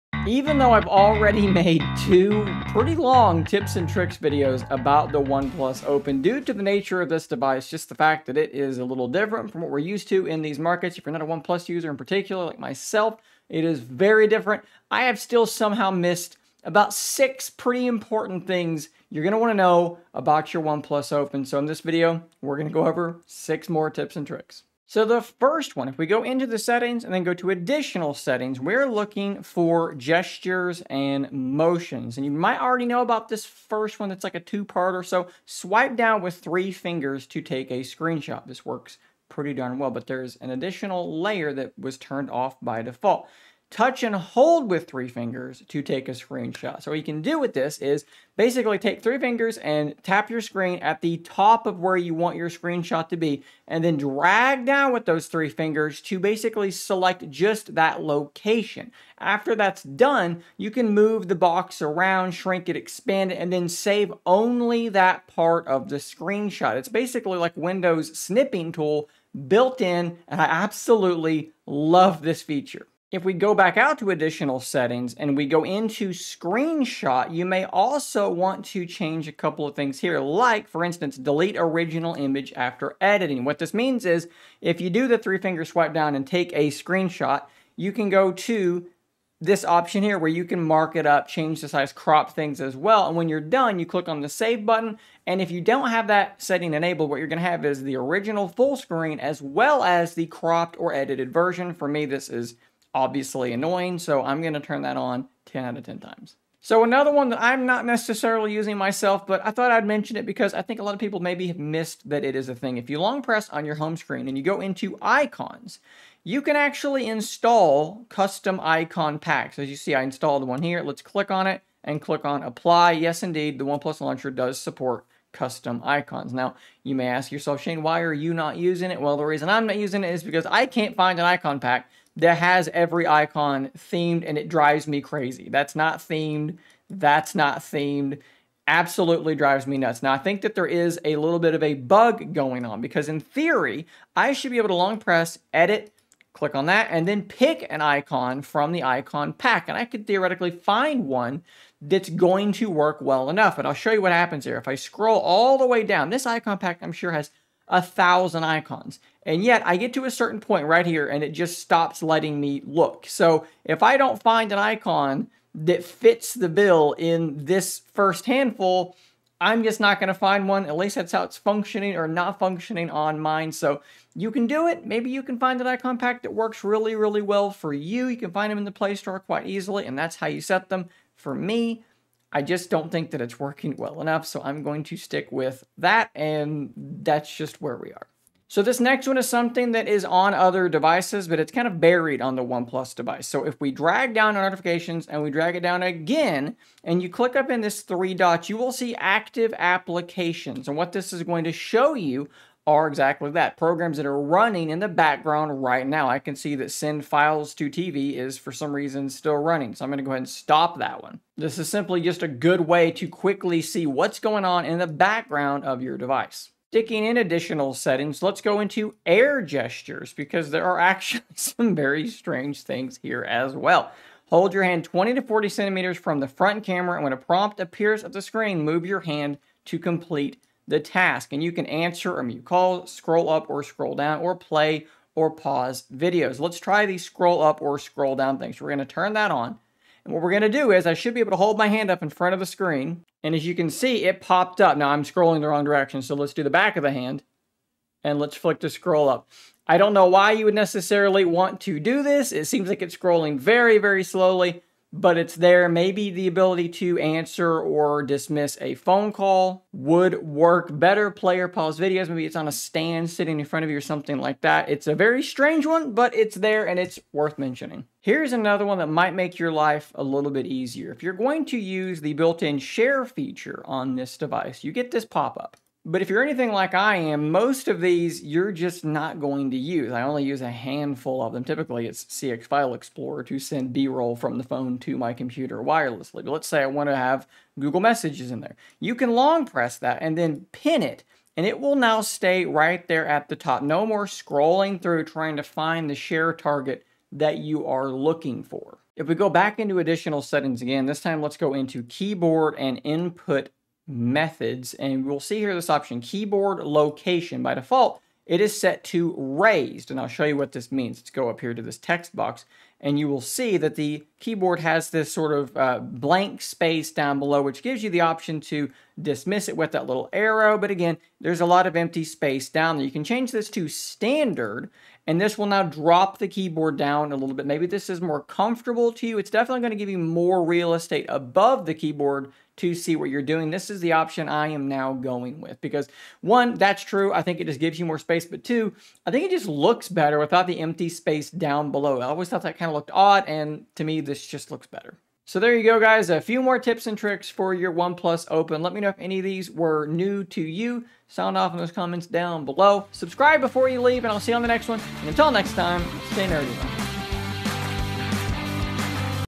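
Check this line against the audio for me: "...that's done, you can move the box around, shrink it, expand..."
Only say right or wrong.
right.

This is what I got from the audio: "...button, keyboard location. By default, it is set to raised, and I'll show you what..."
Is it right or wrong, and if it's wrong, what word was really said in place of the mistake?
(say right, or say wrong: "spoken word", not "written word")
wrong: "option", not "button".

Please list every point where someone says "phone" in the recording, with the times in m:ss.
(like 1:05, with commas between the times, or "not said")
4:18, 4:44.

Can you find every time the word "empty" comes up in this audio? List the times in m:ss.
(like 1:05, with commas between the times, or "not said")
5:21, 5:40.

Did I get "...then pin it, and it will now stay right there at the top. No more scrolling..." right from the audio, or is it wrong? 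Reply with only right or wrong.
right.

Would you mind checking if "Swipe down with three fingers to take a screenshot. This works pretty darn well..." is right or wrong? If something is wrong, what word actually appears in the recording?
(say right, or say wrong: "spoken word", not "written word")
right.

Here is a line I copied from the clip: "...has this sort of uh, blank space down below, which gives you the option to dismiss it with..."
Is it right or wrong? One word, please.
right.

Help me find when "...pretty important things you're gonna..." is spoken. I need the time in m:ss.
0:17.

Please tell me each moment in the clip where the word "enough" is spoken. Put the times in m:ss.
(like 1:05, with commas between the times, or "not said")
2:33, 3:04.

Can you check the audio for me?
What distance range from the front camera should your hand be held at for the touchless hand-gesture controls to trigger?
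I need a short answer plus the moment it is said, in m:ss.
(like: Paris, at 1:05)
20 to 40 centimeters, at 3:44.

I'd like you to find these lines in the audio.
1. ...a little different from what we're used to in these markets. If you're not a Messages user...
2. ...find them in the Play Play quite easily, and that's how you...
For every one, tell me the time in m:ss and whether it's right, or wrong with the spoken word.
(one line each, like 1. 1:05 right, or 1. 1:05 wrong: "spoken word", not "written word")
1. 0:08 wrong: "OnePlus", not "Messages"
2. 2:58 wrong: "Store", not "Play".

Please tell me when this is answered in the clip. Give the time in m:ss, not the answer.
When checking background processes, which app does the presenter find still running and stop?
3:26.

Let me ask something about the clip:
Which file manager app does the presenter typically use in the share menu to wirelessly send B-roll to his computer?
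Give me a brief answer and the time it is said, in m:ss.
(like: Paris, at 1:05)
CX File Explorer, at 4:42.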